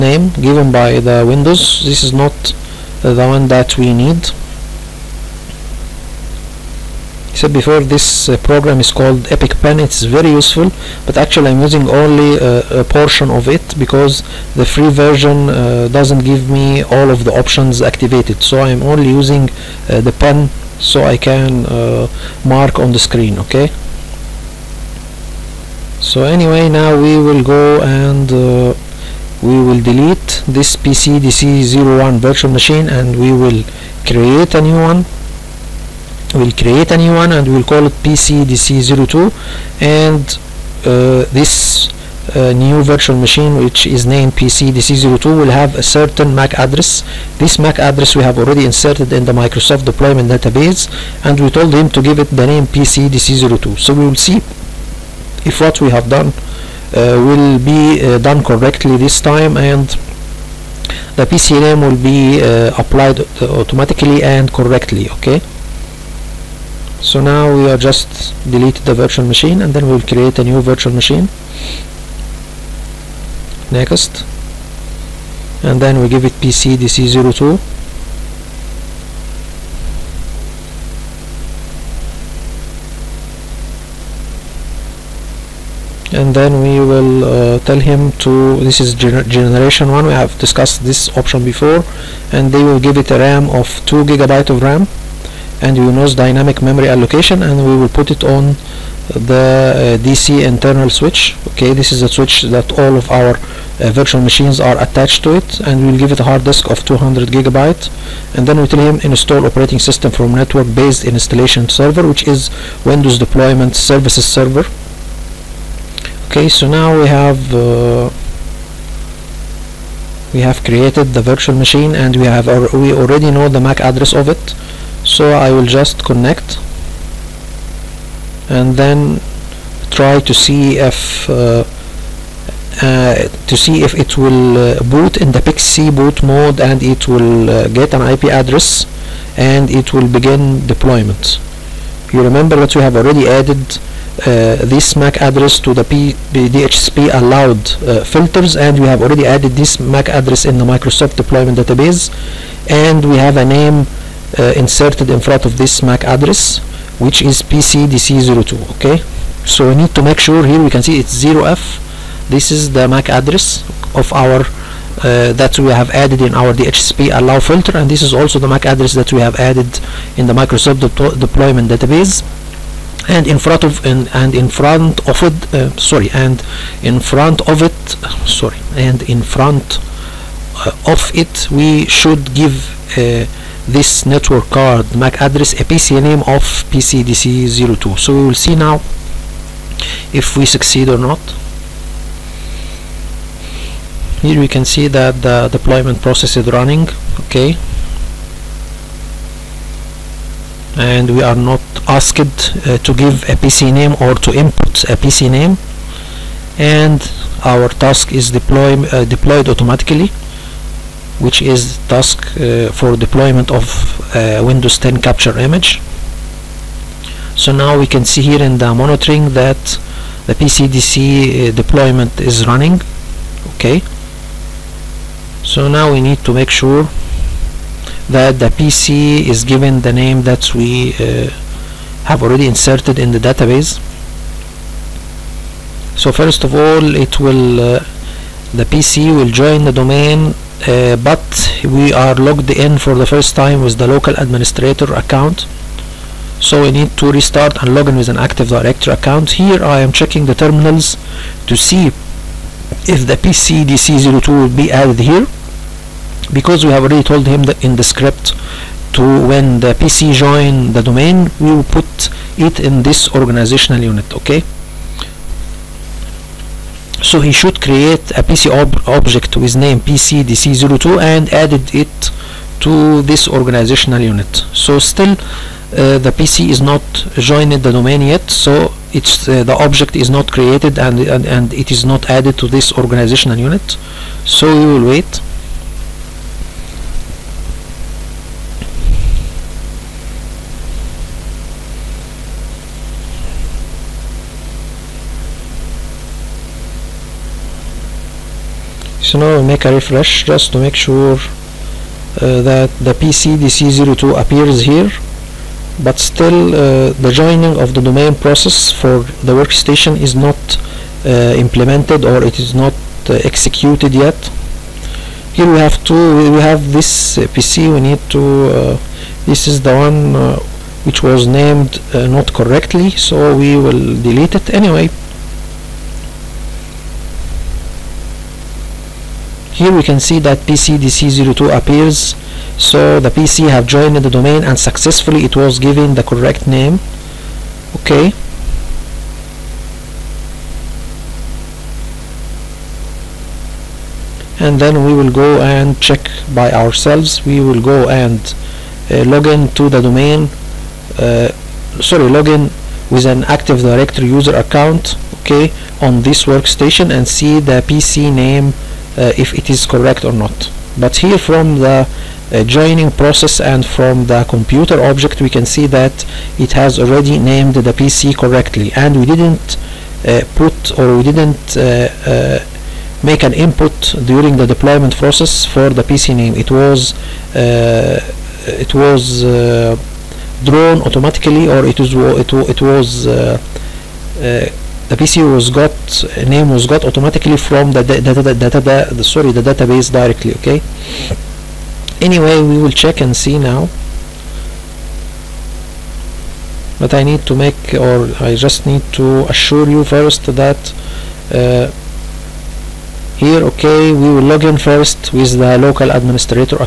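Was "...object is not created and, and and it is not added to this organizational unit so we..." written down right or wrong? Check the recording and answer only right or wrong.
right.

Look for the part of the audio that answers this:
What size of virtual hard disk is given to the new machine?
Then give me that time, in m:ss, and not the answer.
1:46.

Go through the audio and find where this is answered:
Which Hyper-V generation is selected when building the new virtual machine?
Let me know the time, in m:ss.
1:29.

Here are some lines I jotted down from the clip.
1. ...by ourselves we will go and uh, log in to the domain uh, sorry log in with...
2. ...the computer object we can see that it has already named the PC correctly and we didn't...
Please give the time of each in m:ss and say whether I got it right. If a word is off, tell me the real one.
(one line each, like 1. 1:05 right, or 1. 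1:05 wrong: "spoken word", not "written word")
1. 5:46 right
2. 6:04 right.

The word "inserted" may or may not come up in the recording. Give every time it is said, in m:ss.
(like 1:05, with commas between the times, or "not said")
0:48, 2:34, 3:52.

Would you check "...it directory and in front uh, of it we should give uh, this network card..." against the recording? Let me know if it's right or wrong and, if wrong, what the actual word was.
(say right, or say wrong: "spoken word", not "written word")
wrong: "sorry", not "directory".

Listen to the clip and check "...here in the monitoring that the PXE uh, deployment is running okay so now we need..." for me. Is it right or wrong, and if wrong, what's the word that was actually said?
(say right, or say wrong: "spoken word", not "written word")
wrong: "PCDC", not "PXE".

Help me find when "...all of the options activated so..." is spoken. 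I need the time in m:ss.
0:16.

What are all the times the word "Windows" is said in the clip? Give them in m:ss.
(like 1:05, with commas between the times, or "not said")
0:01, 1:52, 3:34.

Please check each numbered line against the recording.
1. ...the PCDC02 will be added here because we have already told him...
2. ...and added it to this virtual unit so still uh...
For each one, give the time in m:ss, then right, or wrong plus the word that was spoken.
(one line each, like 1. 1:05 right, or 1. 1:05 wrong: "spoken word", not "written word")
1. 4:13 right
2. 4:31 wrong: "organizational", not "virtual".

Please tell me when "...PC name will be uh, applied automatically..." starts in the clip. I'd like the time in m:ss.
1:01.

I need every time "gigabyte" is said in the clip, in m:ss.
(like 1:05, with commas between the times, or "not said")
1:34, 1:47.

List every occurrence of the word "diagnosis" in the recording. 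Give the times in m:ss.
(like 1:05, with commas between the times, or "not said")
not said.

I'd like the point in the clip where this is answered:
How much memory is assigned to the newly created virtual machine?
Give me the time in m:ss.
1:33.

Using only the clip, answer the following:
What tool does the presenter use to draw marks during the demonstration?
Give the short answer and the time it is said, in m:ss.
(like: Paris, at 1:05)
Epic Pen, at 0:09.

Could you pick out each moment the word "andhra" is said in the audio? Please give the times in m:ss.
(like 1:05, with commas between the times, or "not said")
not said.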